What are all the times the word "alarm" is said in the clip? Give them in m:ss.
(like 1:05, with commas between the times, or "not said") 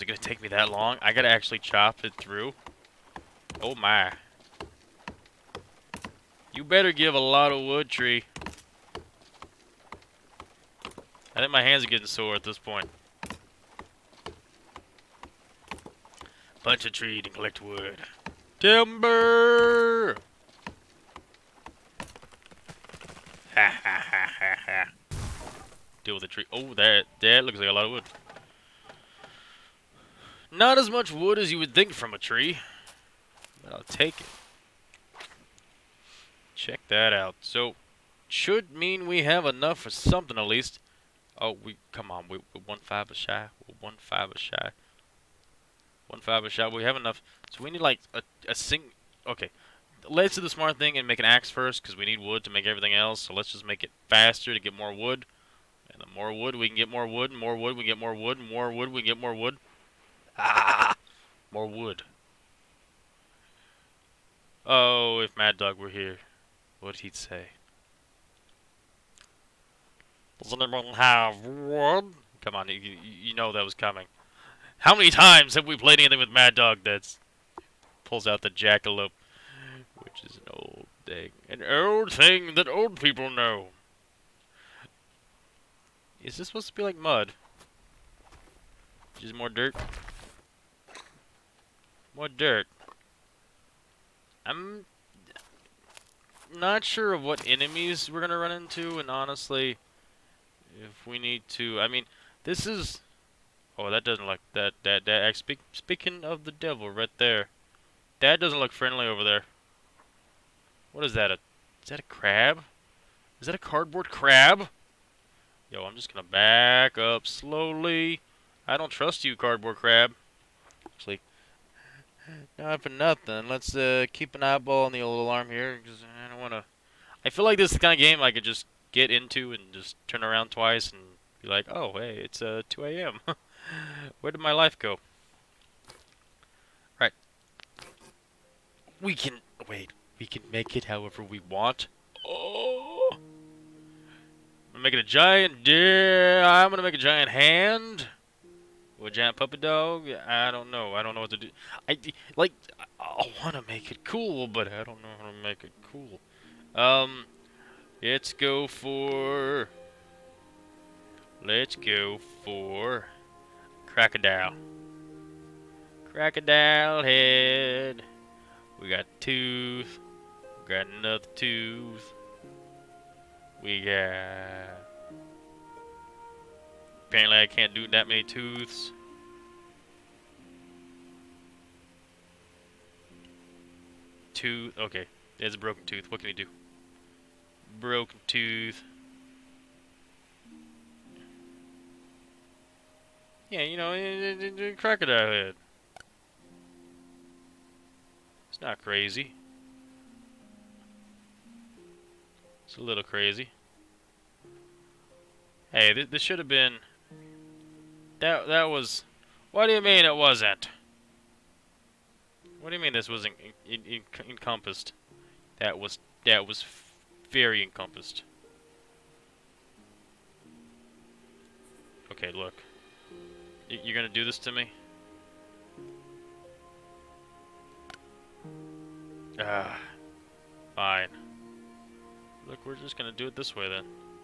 2:05.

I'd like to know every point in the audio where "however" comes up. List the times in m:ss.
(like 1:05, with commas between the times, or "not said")
2:20.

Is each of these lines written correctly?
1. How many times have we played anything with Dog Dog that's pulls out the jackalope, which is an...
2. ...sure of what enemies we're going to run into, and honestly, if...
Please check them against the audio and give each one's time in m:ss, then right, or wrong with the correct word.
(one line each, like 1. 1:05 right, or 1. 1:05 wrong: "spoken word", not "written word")
1. 1:14 wrong: "Mad", not "Dog"
2. 1:36 right.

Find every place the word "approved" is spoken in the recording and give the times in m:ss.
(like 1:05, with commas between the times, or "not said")
not said.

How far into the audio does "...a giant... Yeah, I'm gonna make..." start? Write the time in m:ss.
2:24.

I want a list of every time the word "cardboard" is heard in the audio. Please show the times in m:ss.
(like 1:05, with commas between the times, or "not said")
1:53, 1:59.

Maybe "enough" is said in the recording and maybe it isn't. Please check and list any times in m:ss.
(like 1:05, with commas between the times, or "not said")
0:39, 0:46.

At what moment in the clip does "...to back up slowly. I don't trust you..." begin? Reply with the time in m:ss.
1:56.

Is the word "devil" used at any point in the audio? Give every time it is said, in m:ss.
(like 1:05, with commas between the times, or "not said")
1:46.